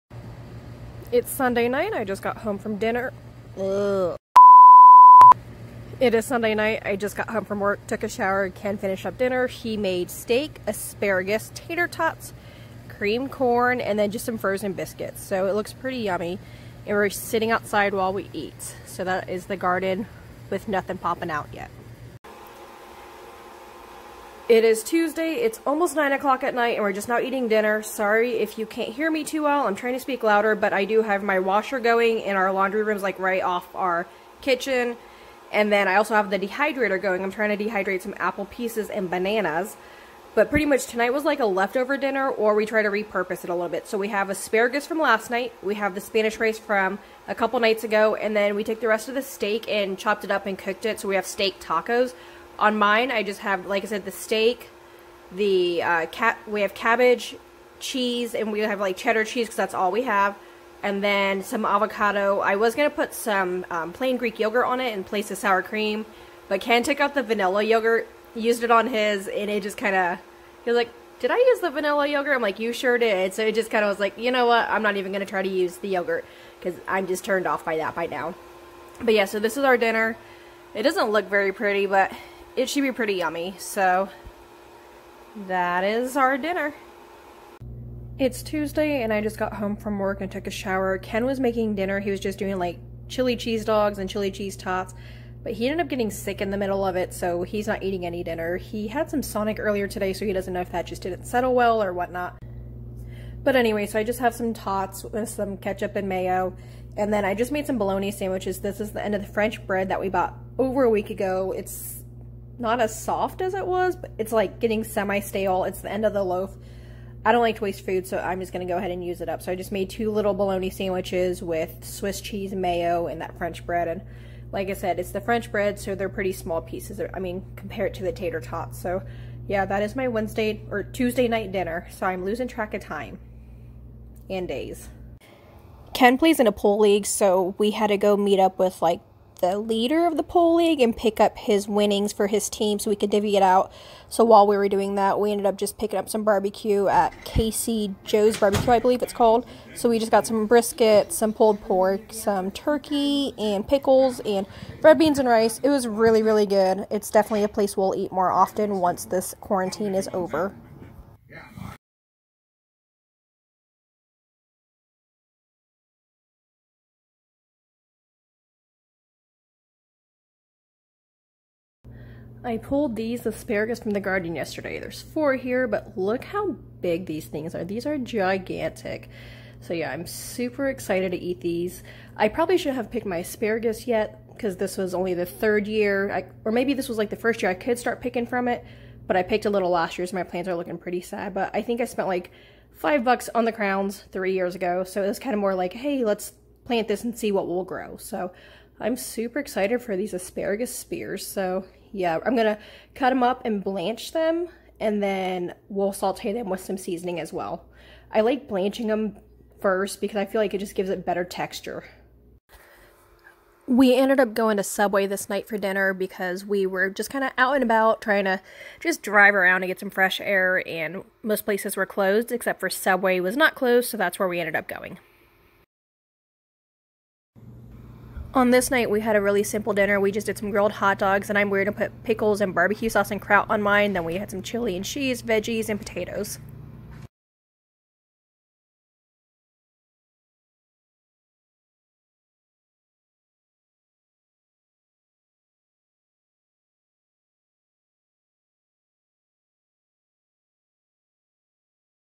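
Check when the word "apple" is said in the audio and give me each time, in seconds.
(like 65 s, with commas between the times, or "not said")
38 s.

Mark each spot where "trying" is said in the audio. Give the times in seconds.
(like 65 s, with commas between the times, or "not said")
29 s, 37 s, 218 s.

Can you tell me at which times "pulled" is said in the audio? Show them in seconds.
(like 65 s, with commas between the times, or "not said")
151 s, 172 s.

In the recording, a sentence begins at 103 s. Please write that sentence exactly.
But anyway, so I just have some tots with some ketchup and mayo.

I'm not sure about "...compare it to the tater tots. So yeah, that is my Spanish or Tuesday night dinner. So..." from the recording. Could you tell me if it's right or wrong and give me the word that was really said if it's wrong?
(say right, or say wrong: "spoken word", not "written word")
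wrong: "Wednesday", not "Spanish".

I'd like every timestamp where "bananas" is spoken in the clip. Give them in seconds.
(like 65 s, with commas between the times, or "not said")
39 s.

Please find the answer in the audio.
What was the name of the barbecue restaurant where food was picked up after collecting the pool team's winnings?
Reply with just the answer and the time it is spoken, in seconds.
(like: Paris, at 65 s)
Casey Joe's Barbecue, at 147 s.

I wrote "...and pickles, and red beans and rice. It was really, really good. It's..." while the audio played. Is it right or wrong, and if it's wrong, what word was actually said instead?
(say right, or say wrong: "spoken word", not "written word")
right.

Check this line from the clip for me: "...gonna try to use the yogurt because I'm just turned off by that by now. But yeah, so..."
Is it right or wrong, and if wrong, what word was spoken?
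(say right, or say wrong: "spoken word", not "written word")
right.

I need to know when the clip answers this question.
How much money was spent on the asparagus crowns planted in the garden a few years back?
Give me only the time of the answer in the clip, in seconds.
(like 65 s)
192 s.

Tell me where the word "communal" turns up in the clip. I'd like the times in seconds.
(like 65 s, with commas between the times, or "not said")
not said.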